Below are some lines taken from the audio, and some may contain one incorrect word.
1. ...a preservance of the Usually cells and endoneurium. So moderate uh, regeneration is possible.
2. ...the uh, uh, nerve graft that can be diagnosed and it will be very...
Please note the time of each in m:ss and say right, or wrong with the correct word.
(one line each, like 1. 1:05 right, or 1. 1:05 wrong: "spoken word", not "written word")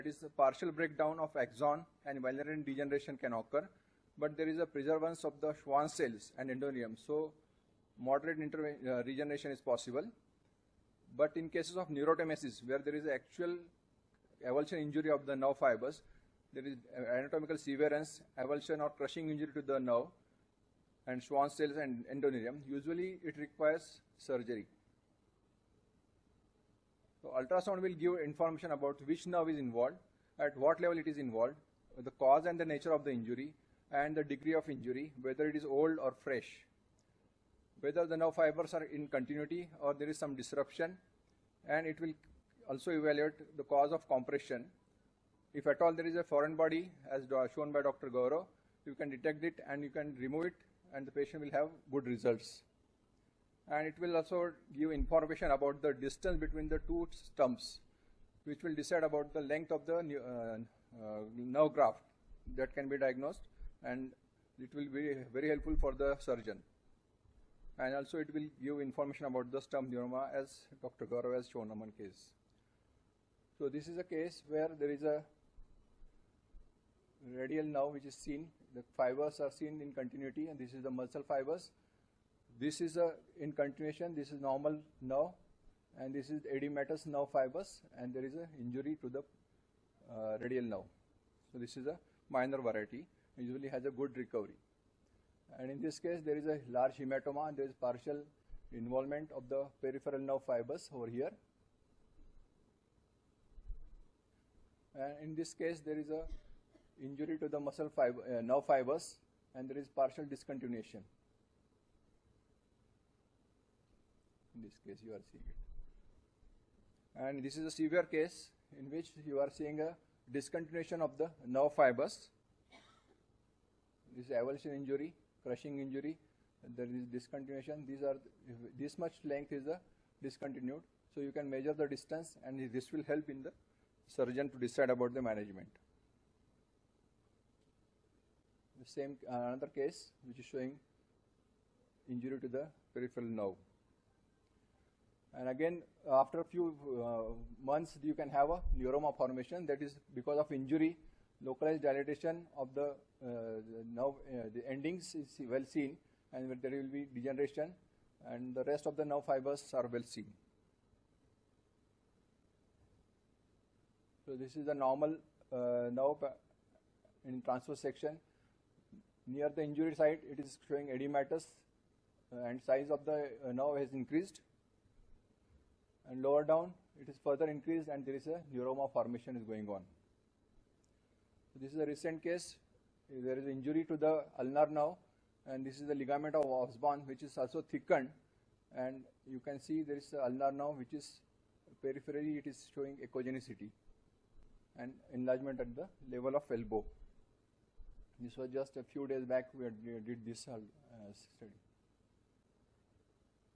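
1. 0:04 wrong: "Schwann", not "Usually"
2. 0:59 right.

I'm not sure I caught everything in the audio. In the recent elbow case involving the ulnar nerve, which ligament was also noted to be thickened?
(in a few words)
Ligament of Osborne.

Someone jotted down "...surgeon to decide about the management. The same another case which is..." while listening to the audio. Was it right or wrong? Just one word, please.
right.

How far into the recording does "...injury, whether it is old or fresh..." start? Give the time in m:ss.
0:34.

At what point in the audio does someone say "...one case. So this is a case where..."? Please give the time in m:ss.
1:11.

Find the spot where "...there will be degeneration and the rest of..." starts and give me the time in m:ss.
2:36.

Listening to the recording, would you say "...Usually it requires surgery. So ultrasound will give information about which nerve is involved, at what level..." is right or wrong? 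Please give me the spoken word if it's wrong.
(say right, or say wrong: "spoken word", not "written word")
right.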